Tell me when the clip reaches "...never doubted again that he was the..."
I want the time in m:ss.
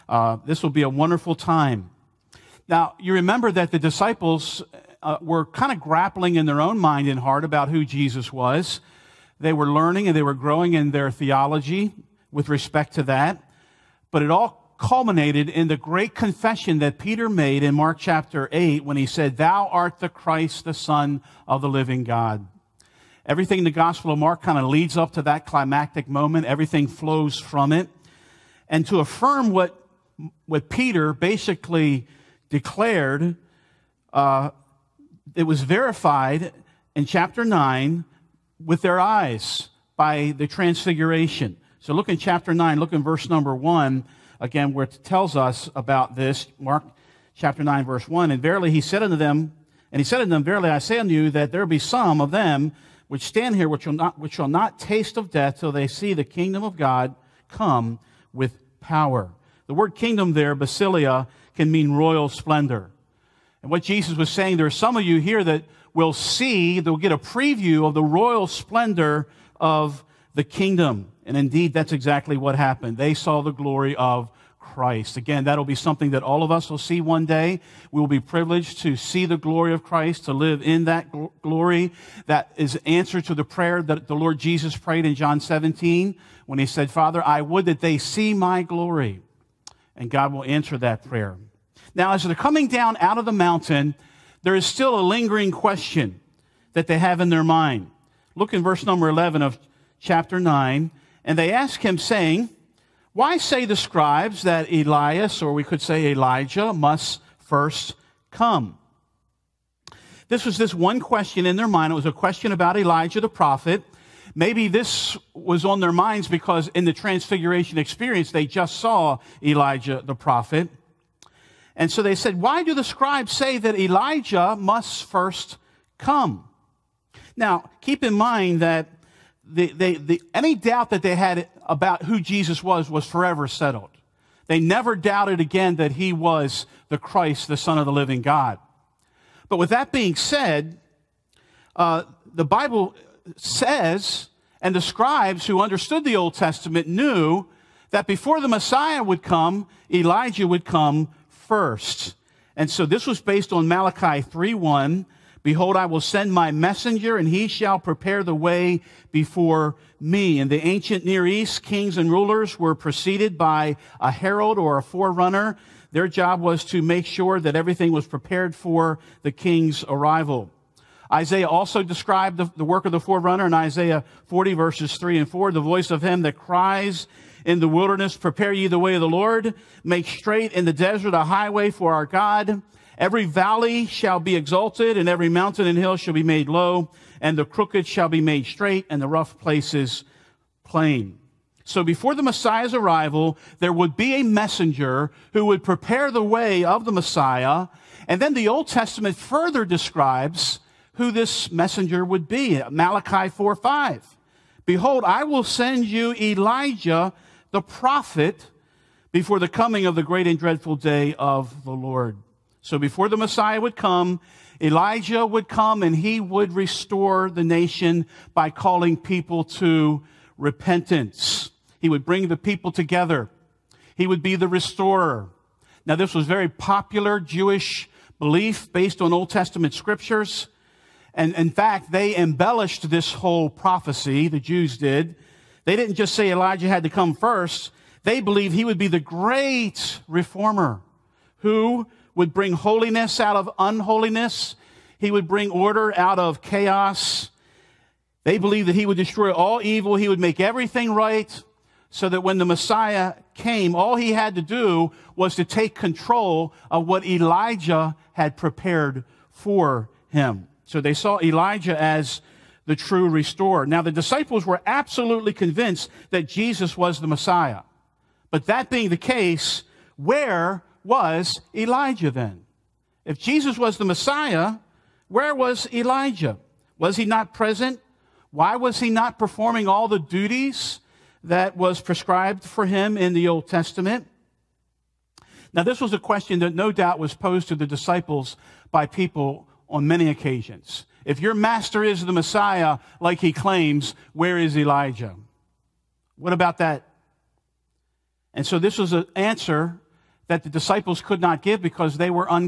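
2:14.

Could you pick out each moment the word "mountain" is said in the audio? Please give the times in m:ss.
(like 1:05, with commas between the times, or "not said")
1:33, 3:05.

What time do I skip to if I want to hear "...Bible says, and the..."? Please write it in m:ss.
2:22.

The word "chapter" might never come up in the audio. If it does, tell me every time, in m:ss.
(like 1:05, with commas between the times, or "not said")
0:18, 0:37, 0:42, 0:47, 1:40.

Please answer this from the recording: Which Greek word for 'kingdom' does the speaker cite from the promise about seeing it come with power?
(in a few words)
basilia.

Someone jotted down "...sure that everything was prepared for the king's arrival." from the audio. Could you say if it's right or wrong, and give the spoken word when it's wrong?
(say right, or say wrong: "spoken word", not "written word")
right.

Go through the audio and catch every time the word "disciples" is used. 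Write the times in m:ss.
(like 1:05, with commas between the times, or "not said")
0:03, 4:23, 4:47, 5:00.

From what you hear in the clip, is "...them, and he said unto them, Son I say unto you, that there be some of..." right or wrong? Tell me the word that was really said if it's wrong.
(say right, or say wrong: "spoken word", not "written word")
wrong: "Verily", not "Son".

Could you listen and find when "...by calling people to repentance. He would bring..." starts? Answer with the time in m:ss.
3:38.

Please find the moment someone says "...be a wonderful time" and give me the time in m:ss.
0:00.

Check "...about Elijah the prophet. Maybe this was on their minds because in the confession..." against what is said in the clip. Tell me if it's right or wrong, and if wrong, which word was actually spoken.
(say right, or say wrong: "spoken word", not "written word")
wrong: "transfiguration", not "confession".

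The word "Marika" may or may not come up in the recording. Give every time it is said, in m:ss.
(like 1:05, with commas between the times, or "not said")
not said.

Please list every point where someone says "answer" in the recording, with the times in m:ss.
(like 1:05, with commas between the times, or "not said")
1:22, 1:30, 4:59.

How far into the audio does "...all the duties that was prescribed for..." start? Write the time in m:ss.
4:39.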